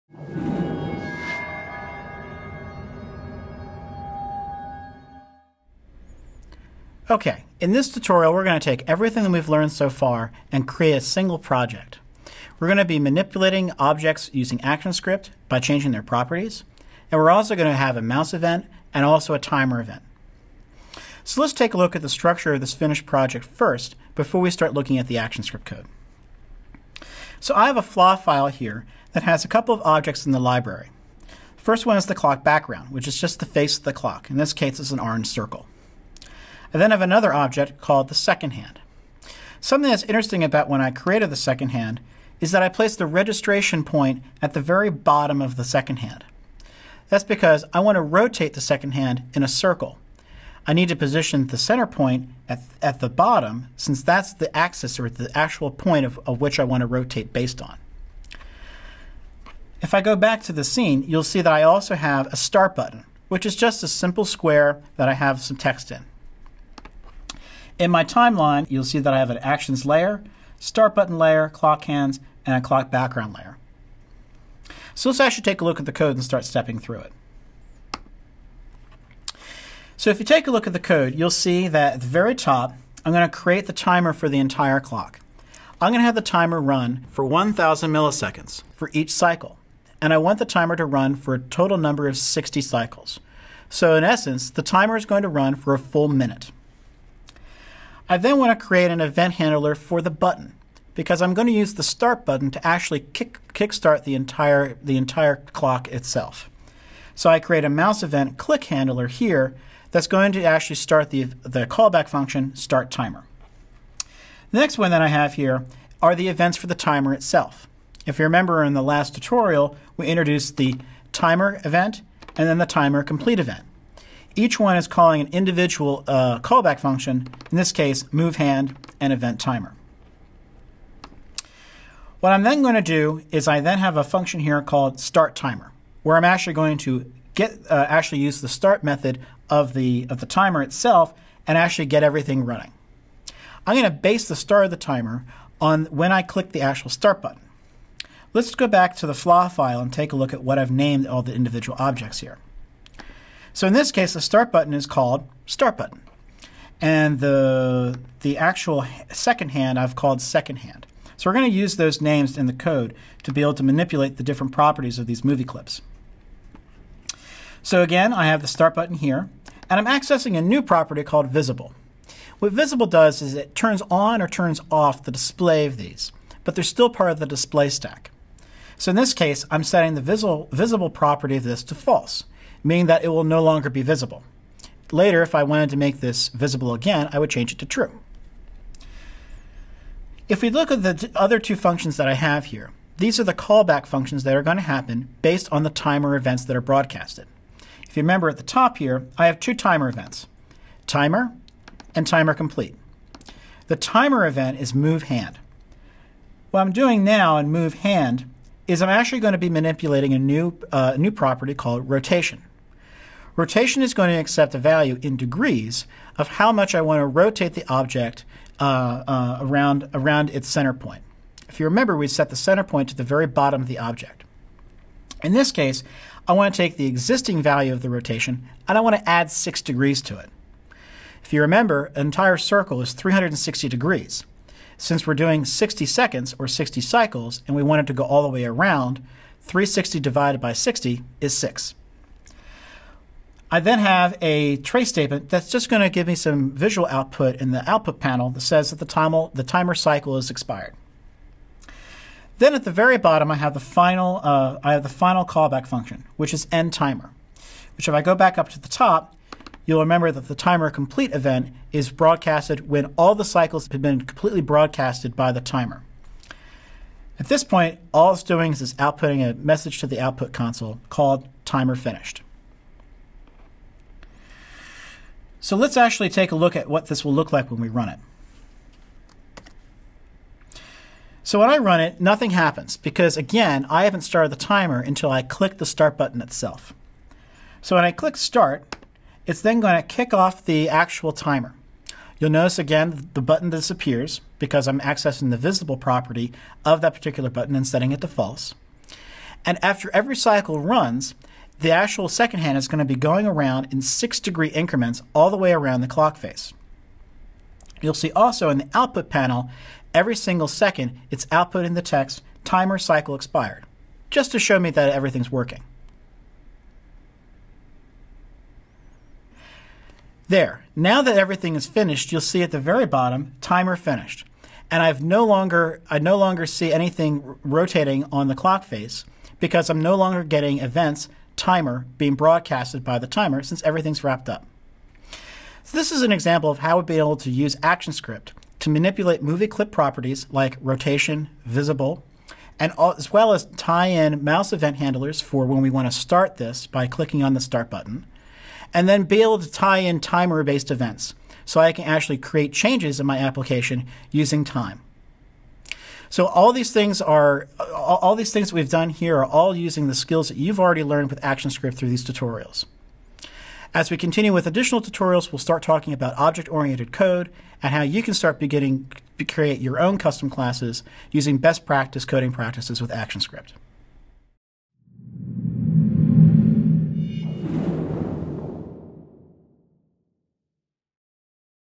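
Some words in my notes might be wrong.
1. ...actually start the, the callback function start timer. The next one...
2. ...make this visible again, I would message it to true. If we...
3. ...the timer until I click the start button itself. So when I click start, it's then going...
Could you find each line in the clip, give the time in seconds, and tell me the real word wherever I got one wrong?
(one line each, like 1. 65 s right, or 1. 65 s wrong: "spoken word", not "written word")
1. 110 s right
2. 185 s wrong: "change", not "message"
3. 284 s right.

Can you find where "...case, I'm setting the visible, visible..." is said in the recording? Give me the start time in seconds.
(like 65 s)
179 s.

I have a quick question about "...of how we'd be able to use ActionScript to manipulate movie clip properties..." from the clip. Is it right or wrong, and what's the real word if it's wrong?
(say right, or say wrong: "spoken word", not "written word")
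right.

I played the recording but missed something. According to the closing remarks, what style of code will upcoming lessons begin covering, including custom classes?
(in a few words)
object-oriented code.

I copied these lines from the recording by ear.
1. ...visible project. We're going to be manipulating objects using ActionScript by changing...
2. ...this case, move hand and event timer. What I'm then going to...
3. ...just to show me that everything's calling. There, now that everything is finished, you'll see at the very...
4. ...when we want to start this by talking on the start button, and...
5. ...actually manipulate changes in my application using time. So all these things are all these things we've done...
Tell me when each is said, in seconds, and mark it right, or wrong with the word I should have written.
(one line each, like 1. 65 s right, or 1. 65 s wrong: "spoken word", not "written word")
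1. 11 s wrong: "single", not "visible"
2. 127 s right
3. 314 s wrong: "working", not "calling"
4. 345 s wrong: "clicking", not "talking"
5. 351 s wrong: "create", not "manipulate".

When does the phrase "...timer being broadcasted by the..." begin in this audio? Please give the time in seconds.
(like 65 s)
331 s.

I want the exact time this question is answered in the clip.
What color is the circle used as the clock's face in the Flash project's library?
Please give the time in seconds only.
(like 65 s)
35 s.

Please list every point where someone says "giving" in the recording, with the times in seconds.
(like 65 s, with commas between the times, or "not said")
not said.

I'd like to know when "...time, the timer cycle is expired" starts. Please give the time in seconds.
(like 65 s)
248 s.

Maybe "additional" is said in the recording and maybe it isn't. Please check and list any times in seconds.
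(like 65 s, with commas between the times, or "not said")
364 s.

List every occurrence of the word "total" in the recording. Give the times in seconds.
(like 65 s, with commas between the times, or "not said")
91 s.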